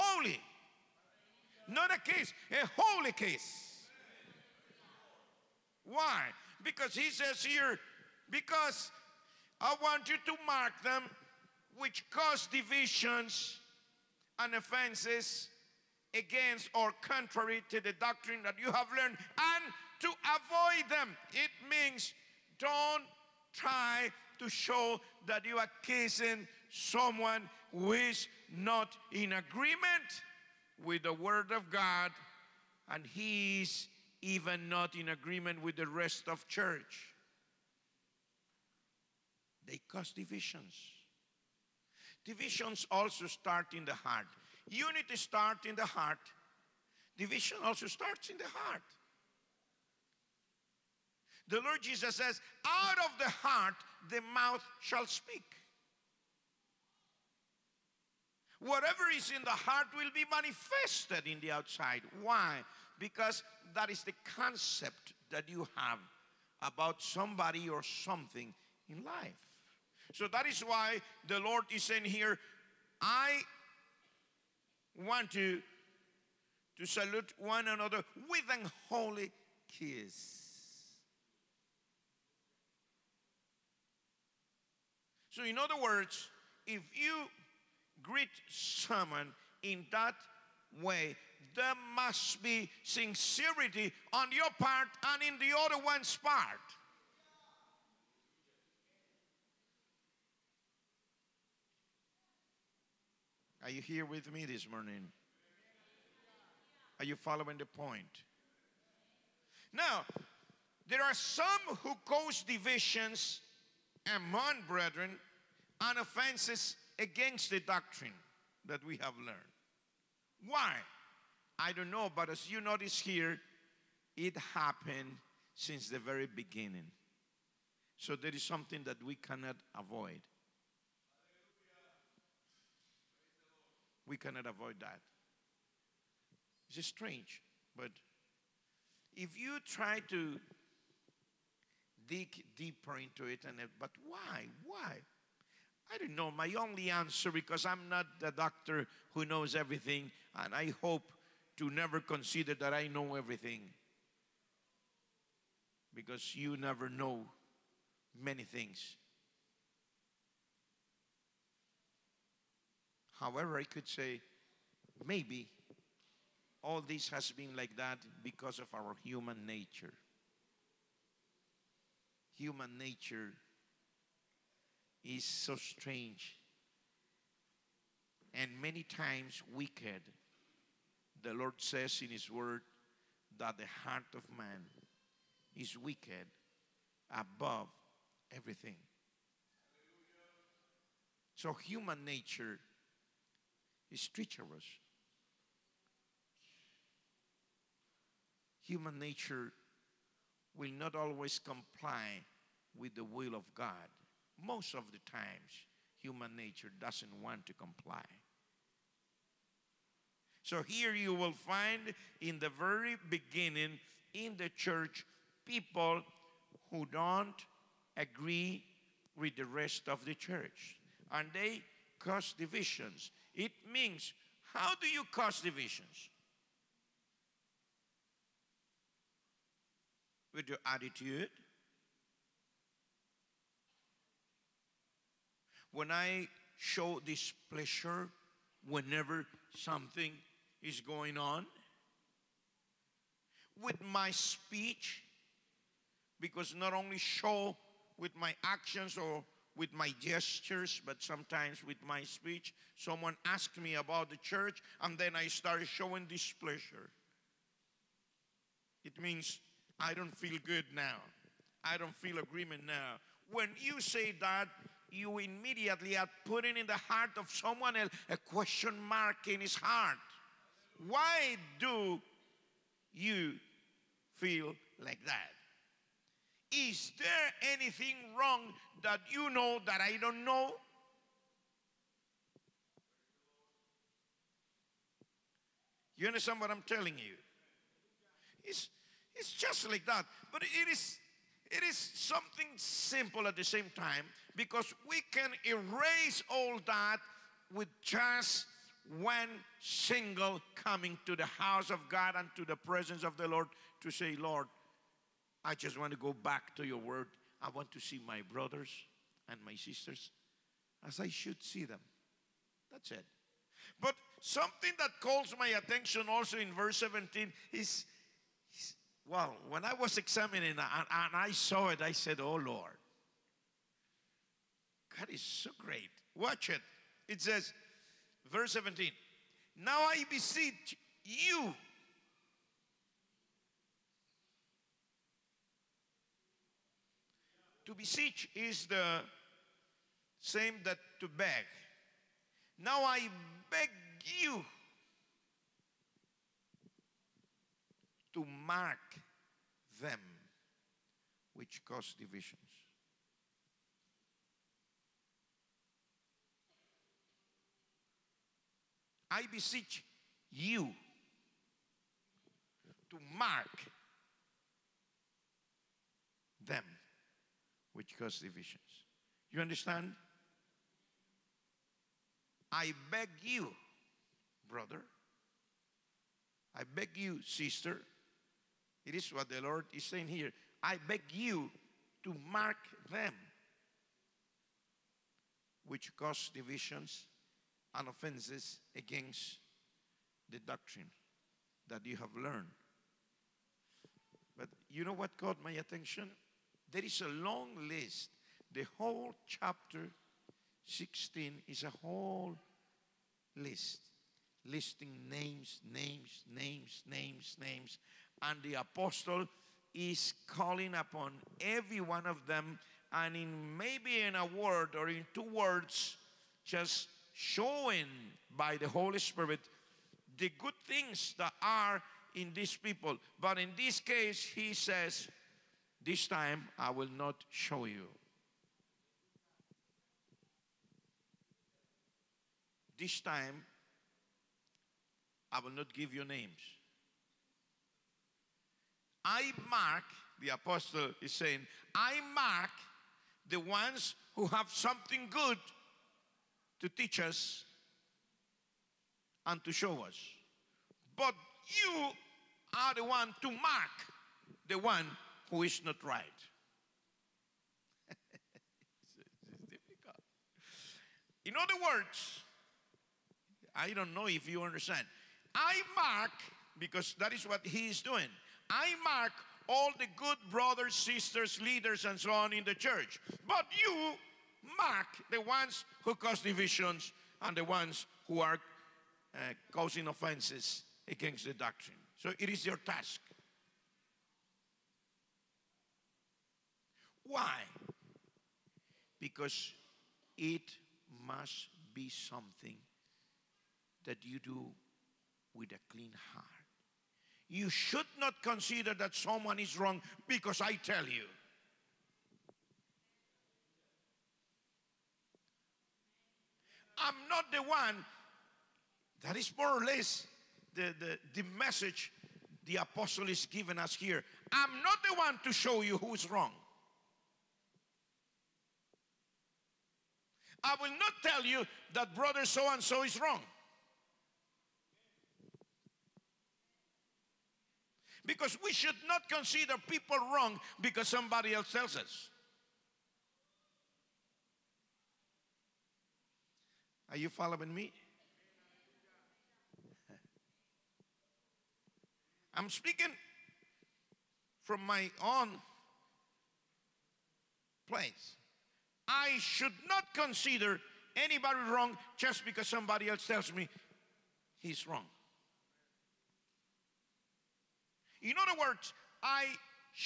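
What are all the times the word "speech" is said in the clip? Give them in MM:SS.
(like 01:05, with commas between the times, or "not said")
04:04, 04:12.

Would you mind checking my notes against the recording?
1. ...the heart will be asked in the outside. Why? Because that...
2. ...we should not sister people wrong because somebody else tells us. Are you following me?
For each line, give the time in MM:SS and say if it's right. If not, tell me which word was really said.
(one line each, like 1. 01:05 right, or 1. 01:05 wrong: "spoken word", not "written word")
1. 00:59 wrong: "manifested", not "asked"
2. 08:48 wrong: "consider", not "sister".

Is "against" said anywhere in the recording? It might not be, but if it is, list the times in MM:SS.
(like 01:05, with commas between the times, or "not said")
00:16, 01:56, 06:28, 08:00.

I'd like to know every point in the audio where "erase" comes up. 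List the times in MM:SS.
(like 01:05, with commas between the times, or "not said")
04:55.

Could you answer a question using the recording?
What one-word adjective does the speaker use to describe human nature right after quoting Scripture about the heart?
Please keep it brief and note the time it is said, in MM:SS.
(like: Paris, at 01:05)
Treacherous, at 03:14.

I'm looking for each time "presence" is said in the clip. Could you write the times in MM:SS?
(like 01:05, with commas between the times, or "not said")
05:02.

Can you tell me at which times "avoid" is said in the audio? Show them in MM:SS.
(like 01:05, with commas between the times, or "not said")
00:20, 02:09, 02:14.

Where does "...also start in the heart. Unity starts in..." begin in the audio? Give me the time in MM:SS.
00:42.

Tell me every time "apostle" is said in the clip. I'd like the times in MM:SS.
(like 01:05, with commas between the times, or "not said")
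06:48, 07:20, 08:32.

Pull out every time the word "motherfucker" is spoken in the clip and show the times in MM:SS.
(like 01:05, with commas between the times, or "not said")
not said.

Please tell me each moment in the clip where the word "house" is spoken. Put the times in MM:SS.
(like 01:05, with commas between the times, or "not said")
05:01.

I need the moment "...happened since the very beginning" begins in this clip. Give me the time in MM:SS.
02:04.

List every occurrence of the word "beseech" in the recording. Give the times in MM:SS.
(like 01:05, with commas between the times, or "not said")
05:30, 05:37, 05:59.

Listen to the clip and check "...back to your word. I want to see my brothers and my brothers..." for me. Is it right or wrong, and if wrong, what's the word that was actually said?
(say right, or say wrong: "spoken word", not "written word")
wrong: "sisters", not "brothers".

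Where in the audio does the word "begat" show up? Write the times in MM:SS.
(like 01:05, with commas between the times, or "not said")
not said.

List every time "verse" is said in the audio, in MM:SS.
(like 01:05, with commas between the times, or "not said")
05:16, 05:28.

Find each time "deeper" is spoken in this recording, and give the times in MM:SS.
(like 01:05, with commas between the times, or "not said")
02:22.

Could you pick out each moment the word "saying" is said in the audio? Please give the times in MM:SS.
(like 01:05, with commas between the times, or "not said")
01:11, 06:19, 07:21.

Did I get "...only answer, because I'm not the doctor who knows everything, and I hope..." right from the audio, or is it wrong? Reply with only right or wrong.
right.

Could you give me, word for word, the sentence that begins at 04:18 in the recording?
It means I don't feel good now.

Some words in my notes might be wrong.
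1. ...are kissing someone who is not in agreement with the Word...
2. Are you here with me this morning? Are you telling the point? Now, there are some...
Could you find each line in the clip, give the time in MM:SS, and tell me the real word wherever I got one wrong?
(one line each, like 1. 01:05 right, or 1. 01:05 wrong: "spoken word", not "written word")
1. 00:25 right
2. 01:43 wrong: "following", not "telling".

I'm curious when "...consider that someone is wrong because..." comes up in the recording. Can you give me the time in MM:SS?
08:18.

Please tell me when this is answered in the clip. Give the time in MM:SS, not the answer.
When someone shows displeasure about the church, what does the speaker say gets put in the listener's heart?
04:28.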